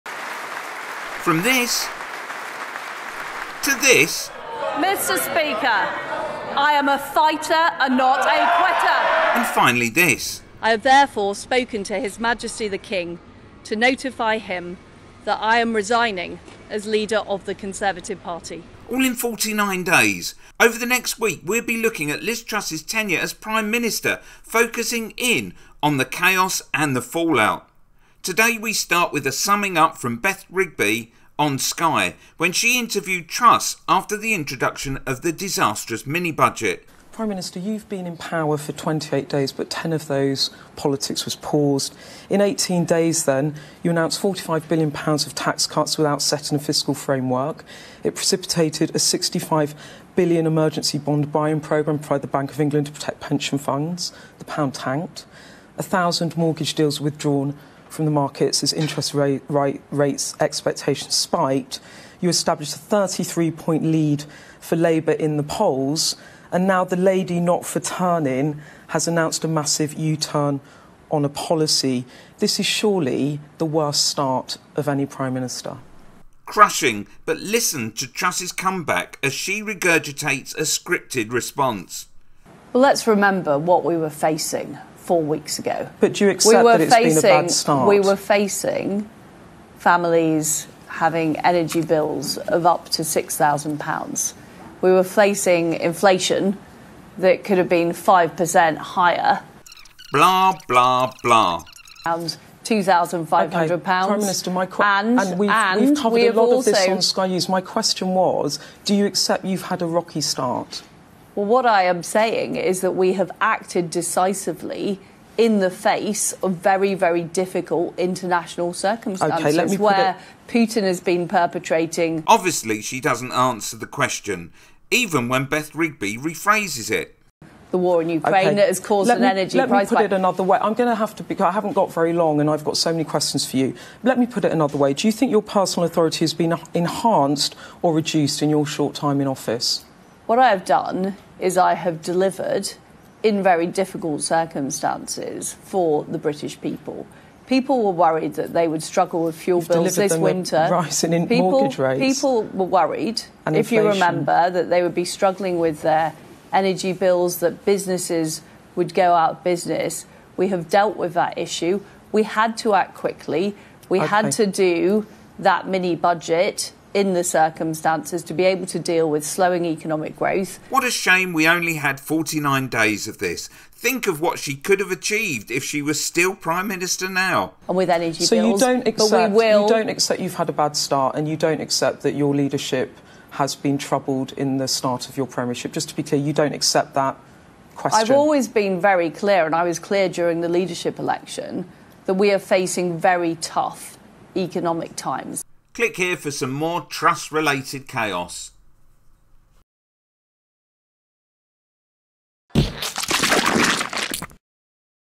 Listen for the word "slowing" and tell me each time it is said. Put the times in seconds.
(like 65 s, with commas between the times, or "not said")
169 s.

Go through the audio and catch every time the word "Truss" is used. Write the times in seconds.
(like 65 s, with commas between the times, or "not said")
22 s, 33 s, 78 s, 196 s.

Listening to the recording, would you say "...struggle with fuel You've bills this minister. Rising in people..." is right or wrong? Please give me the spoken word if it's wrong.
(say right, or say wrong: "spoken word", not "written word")
wrong: "winter", not "minister".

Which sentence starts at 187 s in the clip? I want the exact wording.
I've always been very clear, and I was clear during the leadership election that we are facing very tough economic times.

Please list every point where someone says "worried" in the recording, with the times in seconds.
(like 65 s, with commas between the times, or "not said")
147 s, 152 s.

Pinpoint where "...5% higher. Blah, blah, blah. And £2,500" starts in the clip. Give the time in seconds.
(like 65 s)
97 s.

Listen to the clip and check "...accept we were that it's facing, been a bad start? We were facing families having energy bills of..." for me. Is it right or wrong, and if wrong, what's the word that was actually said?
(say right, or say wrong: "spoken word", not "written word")
right.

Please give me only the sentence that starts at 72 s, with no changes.
This is surely the worst start of any Prime Minister.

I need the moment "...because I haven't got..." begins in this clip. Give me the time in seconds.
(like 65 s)
131 s.